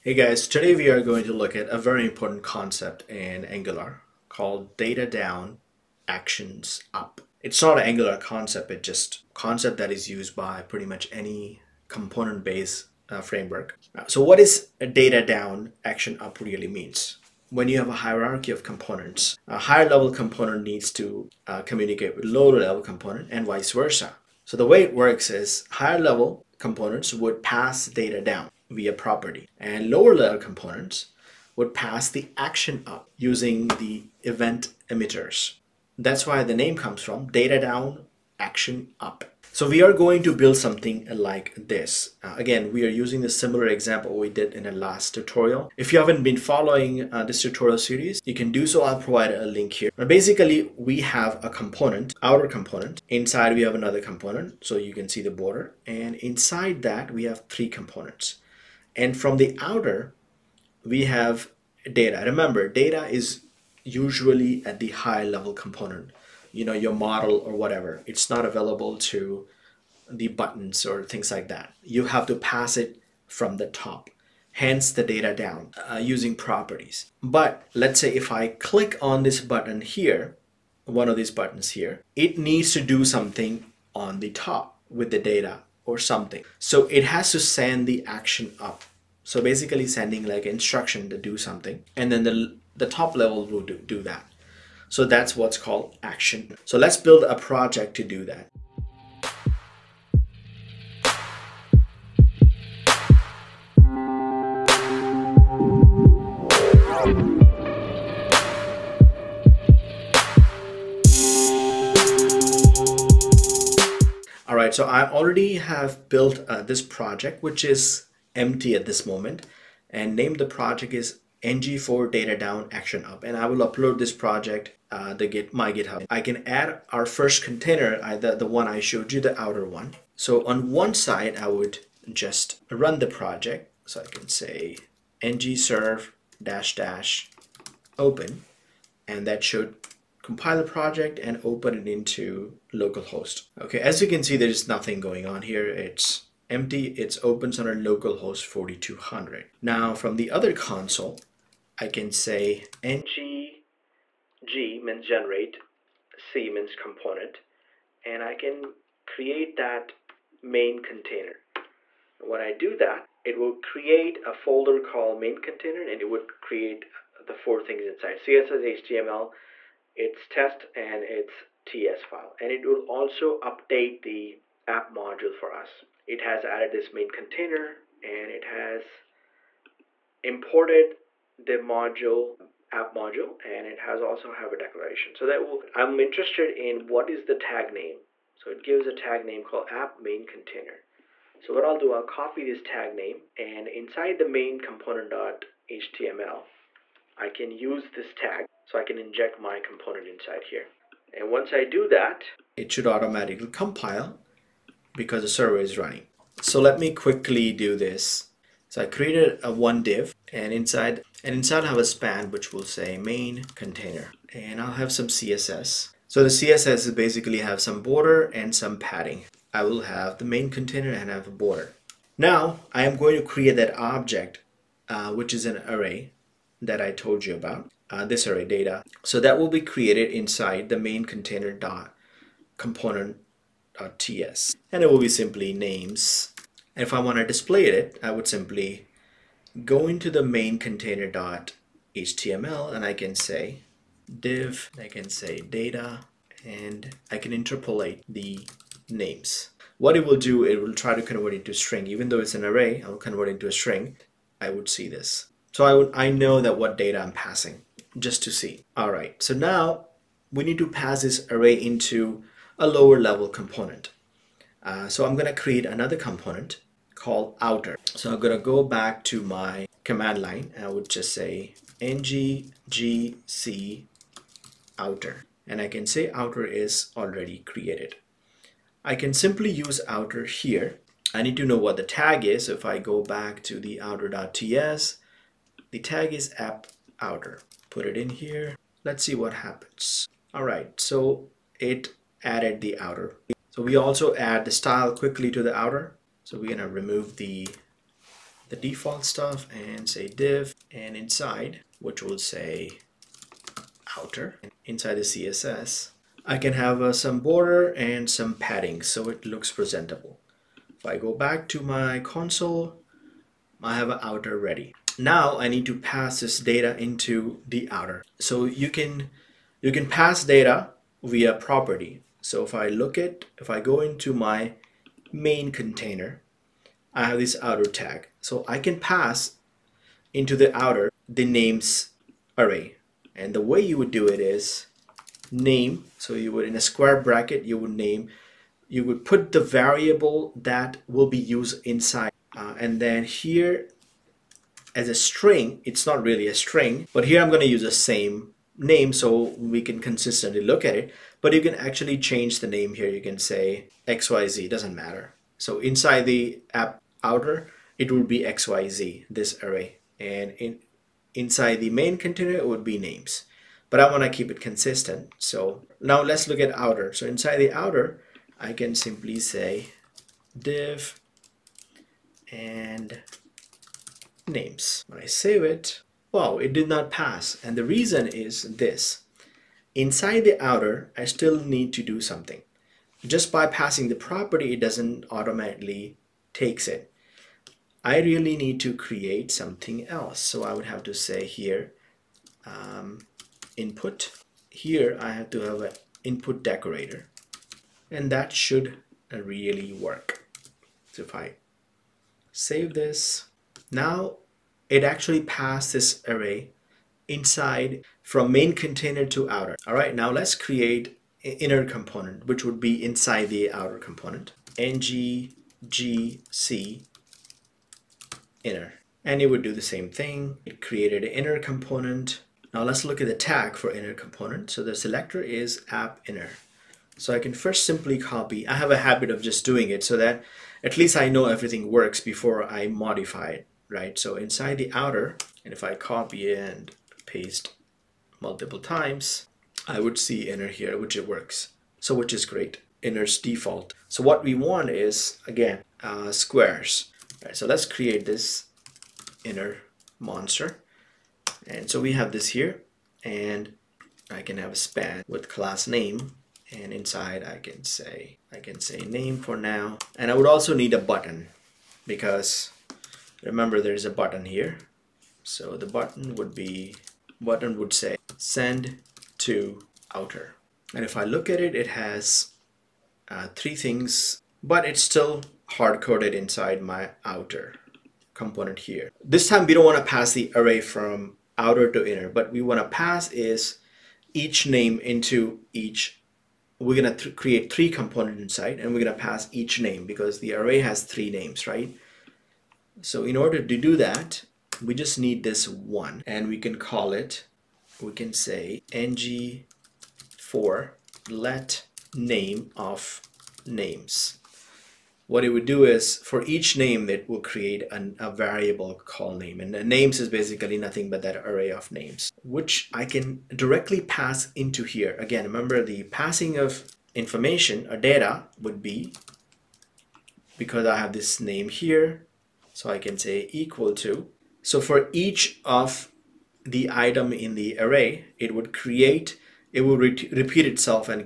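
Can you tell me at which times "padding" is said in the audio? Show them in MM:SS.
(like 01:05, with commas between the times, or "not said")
03:38, 05:08.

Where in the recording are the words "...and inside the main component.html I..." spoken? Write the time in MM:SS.
03:13.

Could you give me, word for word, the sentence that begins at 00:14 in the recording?
So what is a data down, action up really means?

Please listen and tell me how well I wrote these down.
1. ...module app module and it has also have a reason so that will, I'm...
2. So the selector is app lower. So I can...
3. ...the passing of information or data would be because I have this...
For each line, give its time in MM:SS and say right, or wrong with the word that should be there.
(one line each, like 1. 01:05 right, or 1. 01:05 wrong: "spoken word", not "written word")
1. 03:01 wrong: "declaration", not "reason"
2. 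07:04 wrong: "inner", not "lower"
3. 08:35 right.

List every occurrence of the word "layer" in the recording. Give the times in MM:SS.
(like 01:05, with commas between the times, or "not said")
00:30.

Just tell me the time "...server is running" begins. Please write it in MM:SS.
03:25.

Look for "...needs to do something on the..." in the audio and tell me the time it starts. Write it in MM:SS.
01:22.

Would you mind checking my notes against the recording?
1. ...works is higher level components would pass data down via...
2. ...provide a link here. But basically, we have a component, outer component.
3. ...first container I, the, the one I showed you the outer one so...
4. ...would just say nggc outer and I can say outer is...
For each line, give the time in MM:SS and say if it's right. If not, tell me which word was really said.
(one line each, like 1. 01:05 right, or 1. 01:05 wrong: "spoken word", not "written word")
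1. 00:24 right
2. 00:49 right
3. 02:07 right
4. 04:30 right.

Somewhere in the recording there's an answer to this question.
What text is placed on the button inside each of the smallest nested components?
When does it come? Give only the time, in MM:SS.
07:48.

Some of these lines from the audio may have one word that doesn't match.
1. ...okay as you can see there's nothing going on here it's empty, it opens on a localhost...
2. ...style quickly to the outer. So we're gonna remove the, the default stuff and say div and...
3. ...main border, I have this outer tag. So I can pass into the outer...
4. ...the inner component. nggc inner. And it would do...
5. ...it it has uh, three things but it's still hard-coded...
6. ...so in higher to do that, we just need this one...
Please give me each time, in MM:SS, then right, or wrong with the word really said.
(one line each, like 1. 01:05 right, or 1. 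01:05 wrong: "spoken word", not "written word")
1. 02:23 right
2. 04:54 right
3. 05:25 wrong: "container", not "border"
4. 06:53 wrong: "outer", not "inner"
5. 07:51 right
6. 08:12 wrong: "order", not "higher".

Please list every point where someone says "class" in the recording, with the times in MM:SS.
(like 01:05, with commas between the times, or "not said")
07:35.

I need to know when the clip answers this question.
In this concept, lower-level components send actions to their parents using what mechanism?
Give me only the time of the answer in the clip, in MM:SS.
00:34.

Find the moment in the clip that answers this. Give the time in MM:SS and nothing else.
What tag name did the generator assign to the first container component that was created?
03:09.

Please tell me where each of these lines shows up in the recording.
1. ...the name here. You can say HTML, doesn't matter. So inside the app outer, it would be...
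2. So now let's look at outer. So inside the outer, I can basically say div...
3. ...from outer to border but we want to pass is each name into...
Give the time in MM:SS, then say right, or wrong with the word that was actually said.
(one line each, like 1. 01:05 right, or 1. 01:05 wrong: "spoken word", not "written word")
1. 05:52 wrong: "XYZ", not "HTML"
2. 06:05 wrong: "simply", not "basically"
3. 08:00 wrong: "inner", not "border".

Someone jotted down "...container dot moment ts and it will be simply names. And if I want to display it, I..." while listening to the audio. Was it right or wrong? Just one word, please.
wrong.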